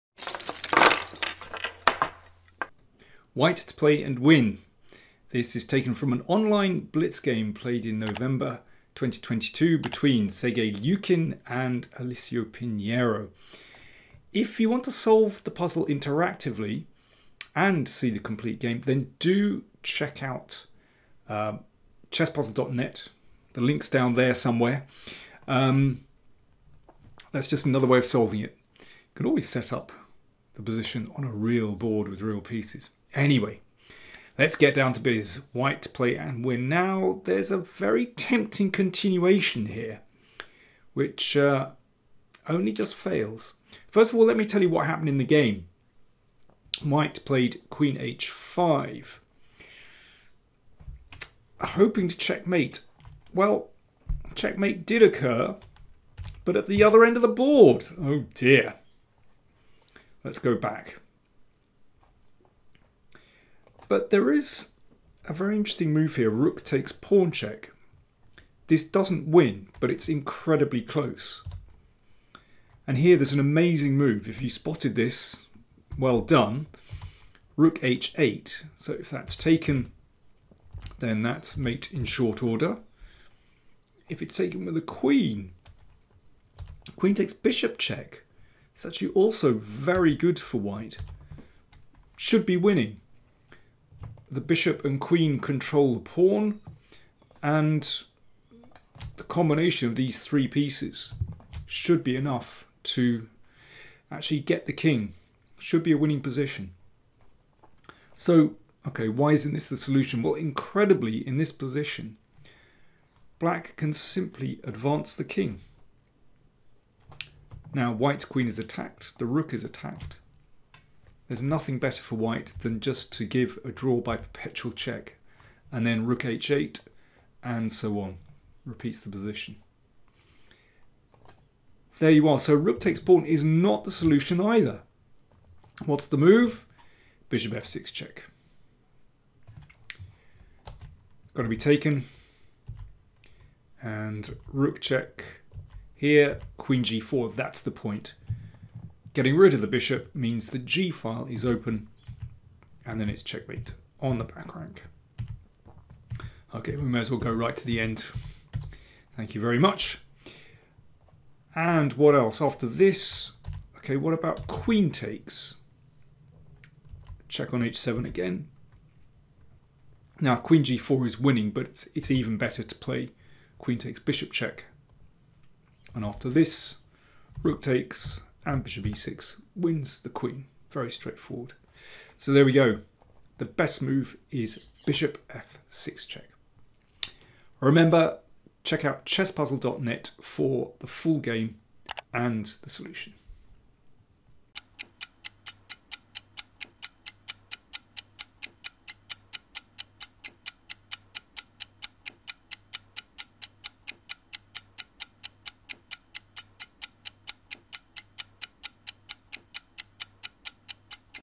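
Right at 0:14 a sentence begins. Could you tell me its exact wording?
If you want to solve the puzzle interactively and see the complete game, then do check out uh, chesspuzzle.net.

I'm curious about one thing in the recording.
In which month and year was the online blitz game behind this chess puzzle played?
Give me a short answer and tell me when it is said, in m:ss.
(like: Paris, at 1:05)
November 2022, at 0:07.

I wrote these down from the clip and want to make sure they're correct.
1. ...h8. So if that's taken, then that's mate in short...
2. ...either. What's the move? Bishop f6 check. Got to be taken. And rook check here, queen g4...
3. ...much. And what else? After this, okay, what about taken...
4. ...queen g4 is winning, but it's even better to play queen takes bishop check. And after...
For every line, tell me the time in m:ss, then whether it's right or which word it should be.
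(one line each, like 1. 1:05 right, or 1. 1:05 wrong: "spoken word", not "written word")
1. 1:17 right
2. 2:14 right
3. 2:39 wrong: "queen", not "taken"
4. 2:50 right.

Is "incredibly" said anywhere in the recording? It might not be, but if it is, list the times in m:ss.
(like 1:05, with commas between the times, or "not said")
1:10, 1:50.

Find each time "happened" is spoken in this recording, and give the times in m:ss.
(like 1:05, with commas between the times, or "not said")
0:44.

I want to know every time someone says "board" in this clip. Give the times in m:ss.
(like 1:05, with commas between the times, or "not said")
0:31, 0:57.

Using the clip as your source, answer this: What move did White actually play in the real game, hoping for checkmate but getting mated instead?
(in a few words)
Queen h5.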